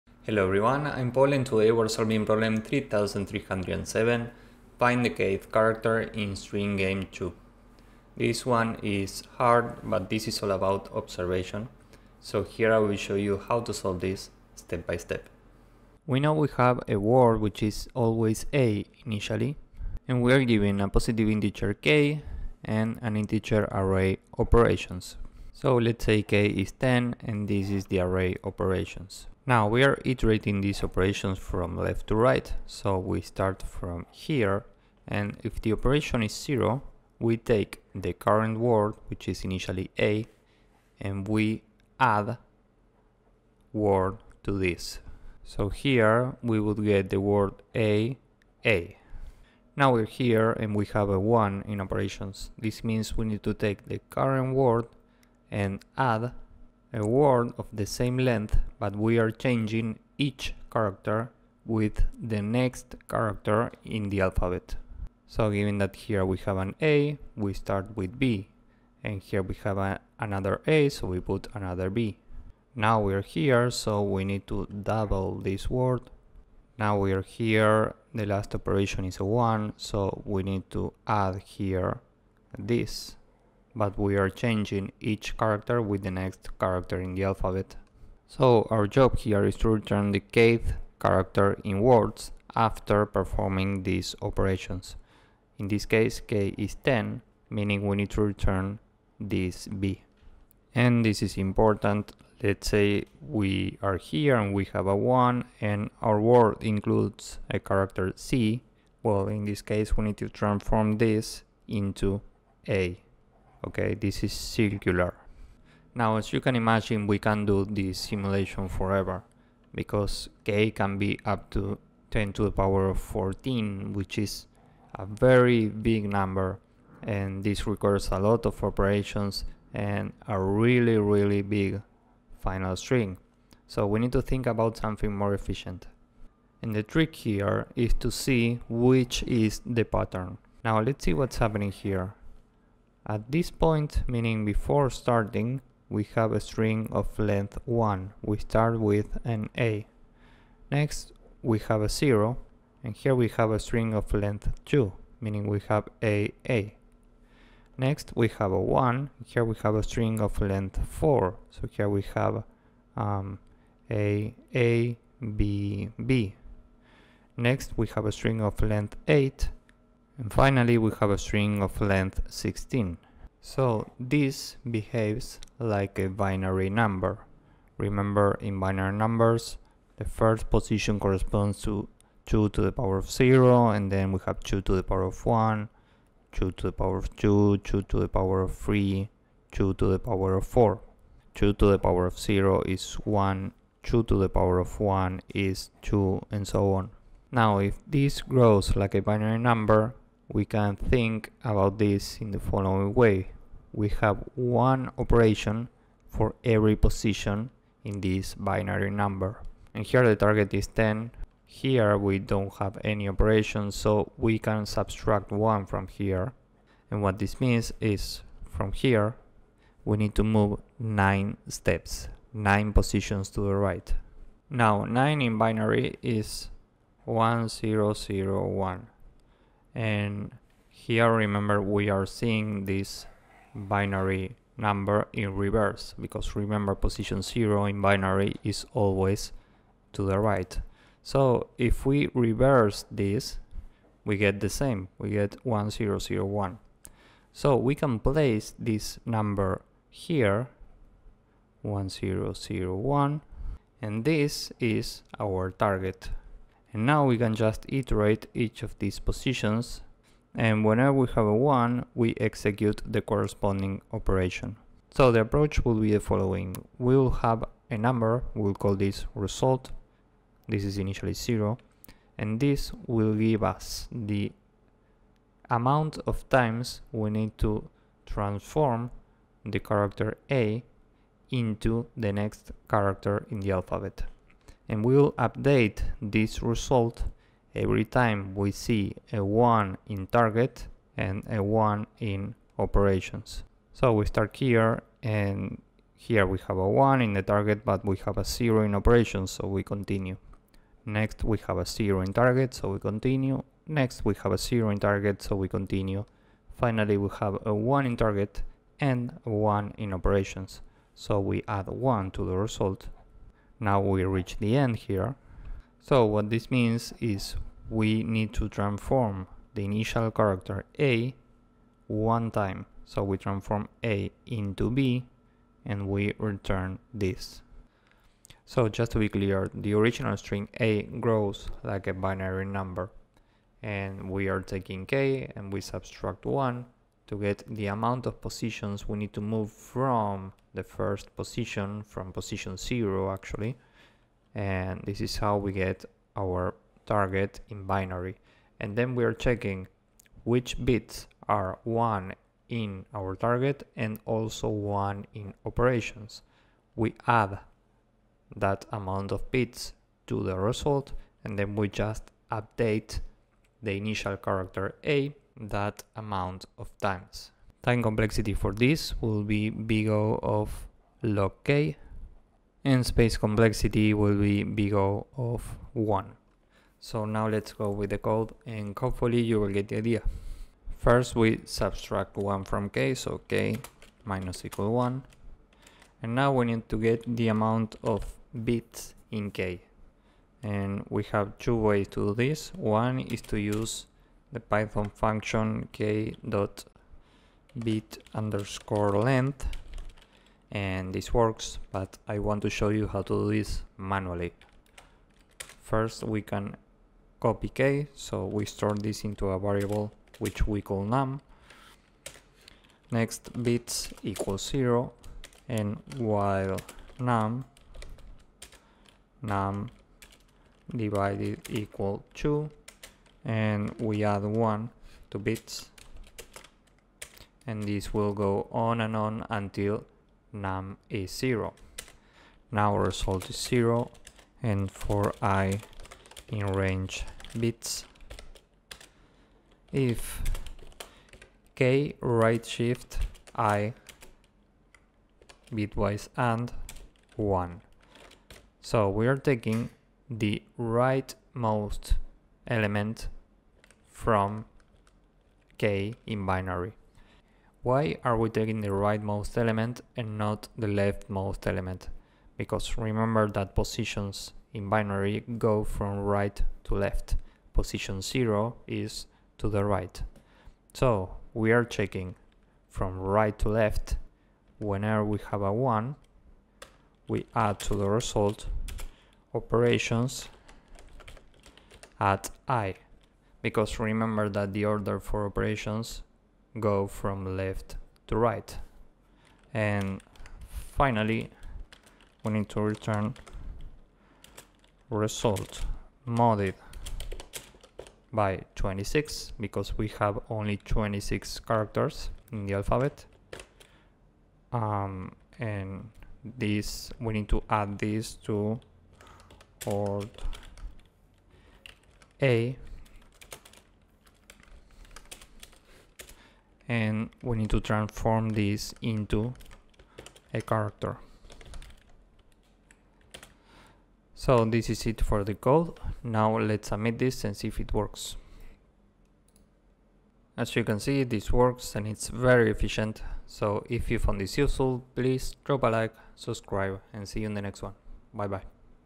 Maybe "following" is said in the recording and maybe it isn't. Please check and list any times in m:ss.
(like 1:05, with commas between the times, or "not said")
3:22, 4:25.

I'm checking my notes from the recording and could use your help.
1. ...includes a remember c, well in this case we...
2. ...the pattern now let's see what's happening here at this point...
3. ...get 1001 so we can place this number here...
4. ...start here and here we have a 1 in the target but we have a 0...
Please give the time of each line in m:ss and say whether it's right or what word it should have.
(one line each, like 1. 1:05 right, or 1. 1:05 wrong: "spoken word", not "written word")
1. 1:46 wrong: "character", not "remember"
2. 2:19 right
3. 4:05 right
4. 4:54 right.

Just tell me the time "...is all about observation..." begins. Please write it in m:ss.
0:10.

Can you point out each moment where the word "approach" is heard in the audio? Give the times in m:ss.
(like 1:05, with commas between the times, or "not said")
4:25.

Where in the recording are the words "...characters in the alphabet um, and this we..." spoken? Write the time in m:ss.
8:21.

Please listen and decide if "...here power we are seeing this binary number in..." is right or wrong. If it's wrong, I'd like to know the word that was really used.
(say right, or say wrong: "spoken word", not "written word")
wrong: "remember", not "power".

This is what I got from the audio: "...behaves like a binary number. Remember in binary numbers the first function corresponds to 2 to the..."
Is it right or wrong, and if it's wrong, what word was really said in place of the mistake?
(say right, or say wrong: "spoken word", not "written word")
wrong: "position", not "function".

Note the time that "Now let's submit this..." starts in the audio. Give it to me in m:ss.
8:46.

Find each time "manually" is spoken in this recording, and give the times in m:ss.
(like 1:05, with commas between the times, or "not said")
6:43.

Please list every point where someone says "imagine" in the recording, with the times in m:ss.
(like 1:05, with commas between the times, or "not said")
1:56.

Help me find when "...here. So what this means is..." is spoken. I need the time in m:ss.
5:14.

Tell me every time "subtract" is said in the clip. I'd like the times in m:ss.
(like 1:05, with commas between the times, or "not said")
3:34, 5:35, 6:21.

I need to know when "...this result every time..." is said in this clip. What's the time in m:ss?
4:46.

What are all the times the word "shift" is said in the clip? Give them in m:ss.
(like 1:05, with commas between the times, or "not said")
7:22.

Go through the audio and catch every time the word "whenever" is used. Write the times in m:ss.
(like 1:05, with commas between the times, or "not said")
4:20, 7:54.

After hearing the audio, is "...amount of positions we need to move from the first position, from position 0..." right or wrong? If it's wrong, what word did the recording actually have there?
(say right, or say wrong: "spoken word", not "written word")
right.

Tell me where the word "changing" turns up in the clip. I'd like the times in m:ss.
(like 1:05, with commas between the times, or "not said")
0:59, 1:24.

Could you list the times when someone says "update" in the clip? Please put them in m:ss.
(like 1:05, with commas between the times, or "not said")
4:45, 6:02.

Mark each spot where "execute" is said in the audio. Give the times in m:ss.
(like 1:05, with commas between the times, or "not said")
4:22.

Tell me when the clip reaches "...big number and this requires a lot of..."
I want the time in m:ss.
2:05.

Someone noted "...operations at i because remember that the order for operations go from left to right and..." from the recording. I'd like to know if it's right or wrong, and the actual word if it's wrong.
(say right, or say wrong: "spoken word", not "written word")
right.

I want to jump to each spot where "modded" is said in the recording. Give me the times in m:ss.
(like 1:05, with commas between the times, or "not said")
8:16.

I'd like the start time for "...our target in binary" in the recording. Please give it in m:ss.
5:46.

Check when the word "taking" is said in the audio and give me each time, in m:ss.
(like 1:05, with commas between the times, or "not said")
5:34, 7:29, 7:38.